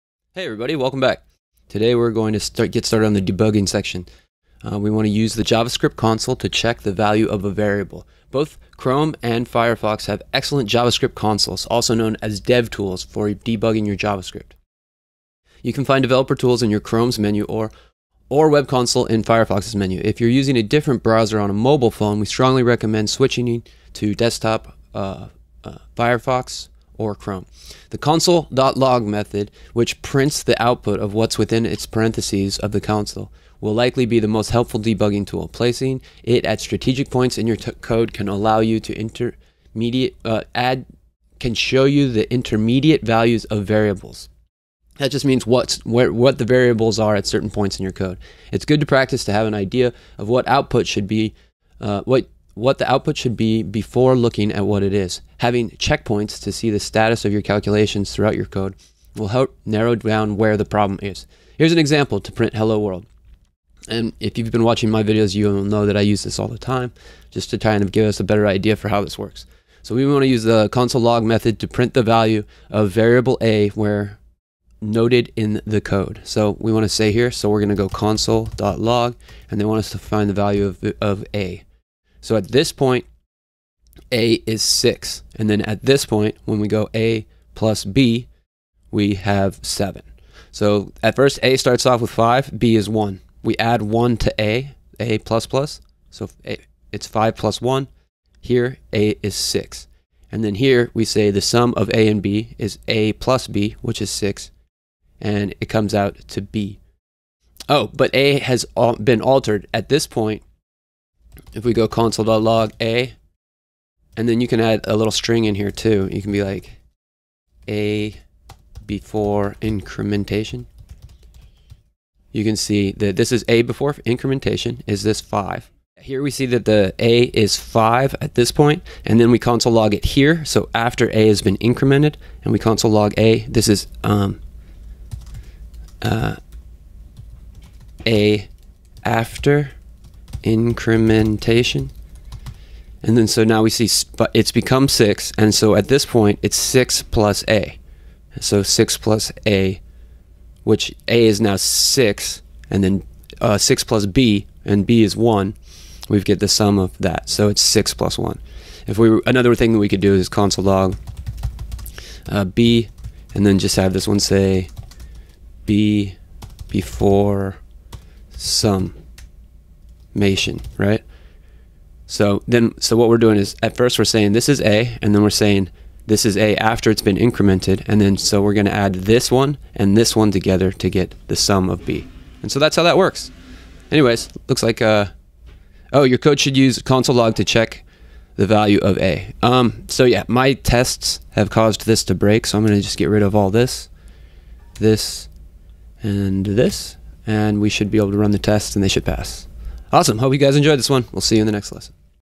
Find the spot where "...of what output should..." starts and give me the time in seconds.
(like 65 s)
50 s.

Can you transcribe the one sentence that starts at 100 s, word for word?
And then here, we say the sum of A and B is A plus B, which is 6.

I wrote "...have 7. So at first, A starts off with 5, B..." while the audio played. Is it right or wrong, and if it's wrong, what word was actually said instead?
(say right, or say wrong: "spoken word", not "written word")
right.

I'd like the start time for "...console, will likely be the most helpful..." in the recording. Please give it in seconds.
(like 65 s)
32 s.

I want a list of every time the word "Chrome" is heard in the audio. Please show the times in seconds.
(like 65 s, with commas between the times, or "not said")
8 s, 16 s, 27 s.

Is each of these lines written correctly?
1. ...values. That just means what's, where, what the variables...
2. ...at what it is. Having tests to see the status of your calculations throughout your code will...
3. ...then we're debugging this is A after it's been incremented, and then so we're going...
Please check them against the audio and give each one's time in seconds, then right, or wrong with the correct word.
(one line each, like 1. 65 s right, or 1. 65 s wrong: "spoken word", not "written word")
1. 43 s wrong: "variables", not "values"
2. 54 s wrong: "checkpoints", not "tests"
3. 175 s wrong: "saying", not "debugging".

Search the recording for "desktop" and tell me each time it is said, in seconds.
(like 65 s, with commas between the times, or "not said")
24 s.